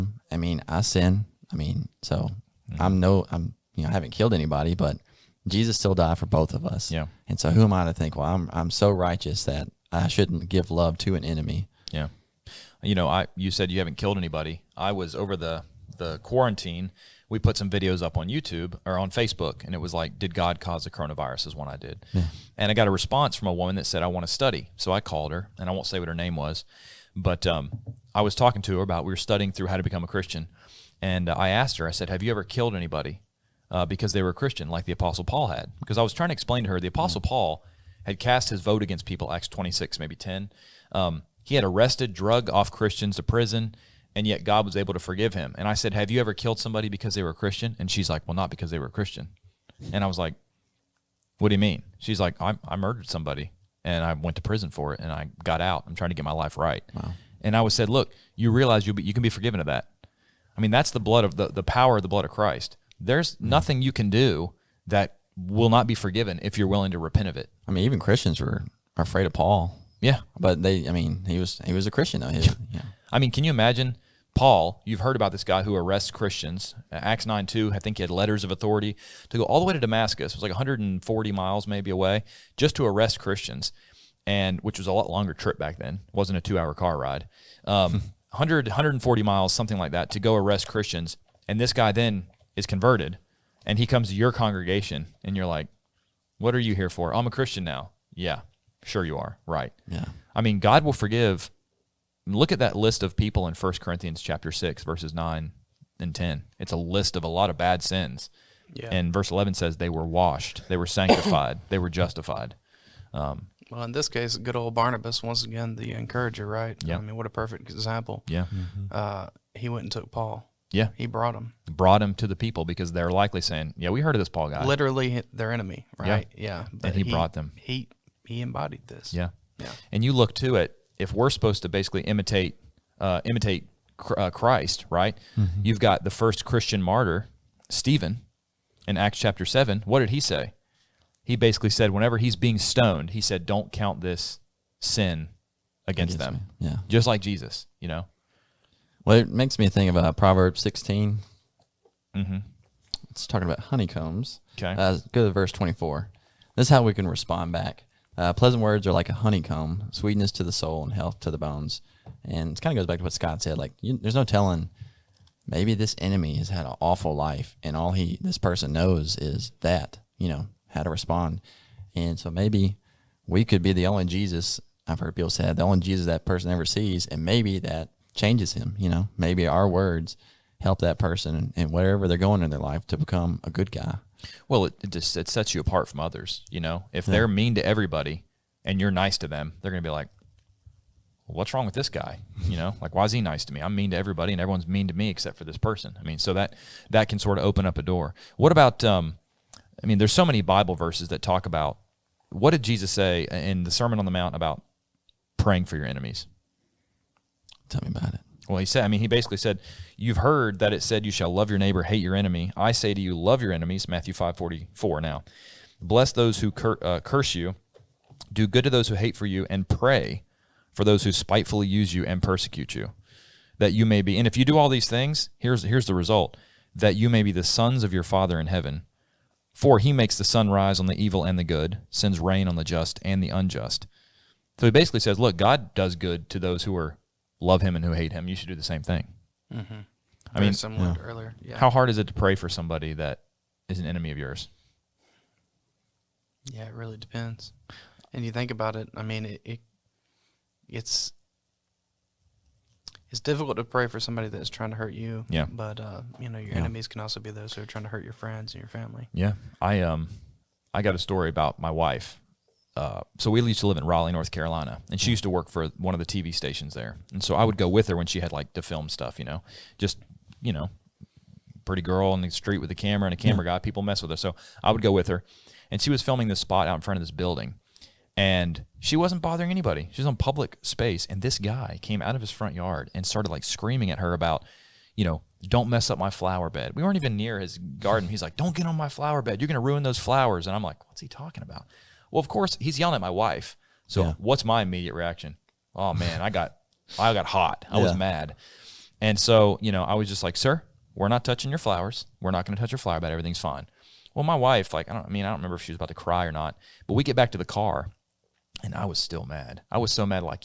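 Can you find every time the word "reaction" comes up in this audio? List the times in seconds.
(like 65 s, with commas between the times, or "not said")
294 s.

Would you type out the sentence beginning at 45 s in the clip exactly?
And I said, Have you ever killed somebody because they were a Christian?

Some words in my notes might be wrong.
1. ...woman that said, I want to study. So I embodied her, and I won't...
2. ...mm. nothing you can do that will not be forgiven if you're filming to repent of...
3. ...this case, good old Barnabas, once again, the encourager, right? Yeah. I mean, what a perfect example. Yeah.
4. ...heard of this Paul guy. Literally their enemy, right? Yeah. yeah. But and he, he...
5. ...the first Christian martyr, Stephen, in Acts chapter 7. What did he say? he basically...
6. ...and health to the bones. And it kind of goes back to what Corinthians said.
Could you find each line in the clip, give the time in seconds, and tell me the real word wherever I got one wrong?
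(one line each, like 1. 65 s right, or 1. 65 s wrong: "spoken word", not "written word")
1. 23 s wrong: "called", not "embodied"
2. 63 s wrong: "willing", not "filming"
3. 113 s right
4. 124 s right
5. 136 s right
6. 160 s wrong: "Scott", not "Corinthians".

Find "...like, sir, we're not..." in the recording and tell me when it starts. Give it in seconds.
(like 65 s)
300 s.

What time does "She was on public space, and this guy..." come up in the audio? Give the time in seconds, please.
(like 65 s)
279 s.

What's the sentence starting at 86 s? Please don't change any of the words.
wasn't a two hour car ride.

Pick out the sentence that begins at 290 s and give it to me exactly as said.
And I'm like, what's he talking about?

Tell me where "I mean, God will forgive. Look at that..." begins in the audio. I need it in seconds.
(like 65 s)
100 s.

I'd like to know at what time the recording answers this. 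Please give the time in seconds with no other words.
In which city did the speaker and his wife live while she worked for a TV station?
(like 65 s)
263 s.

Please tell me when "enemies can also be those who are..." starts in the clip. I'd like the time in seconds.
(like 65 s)
256 s.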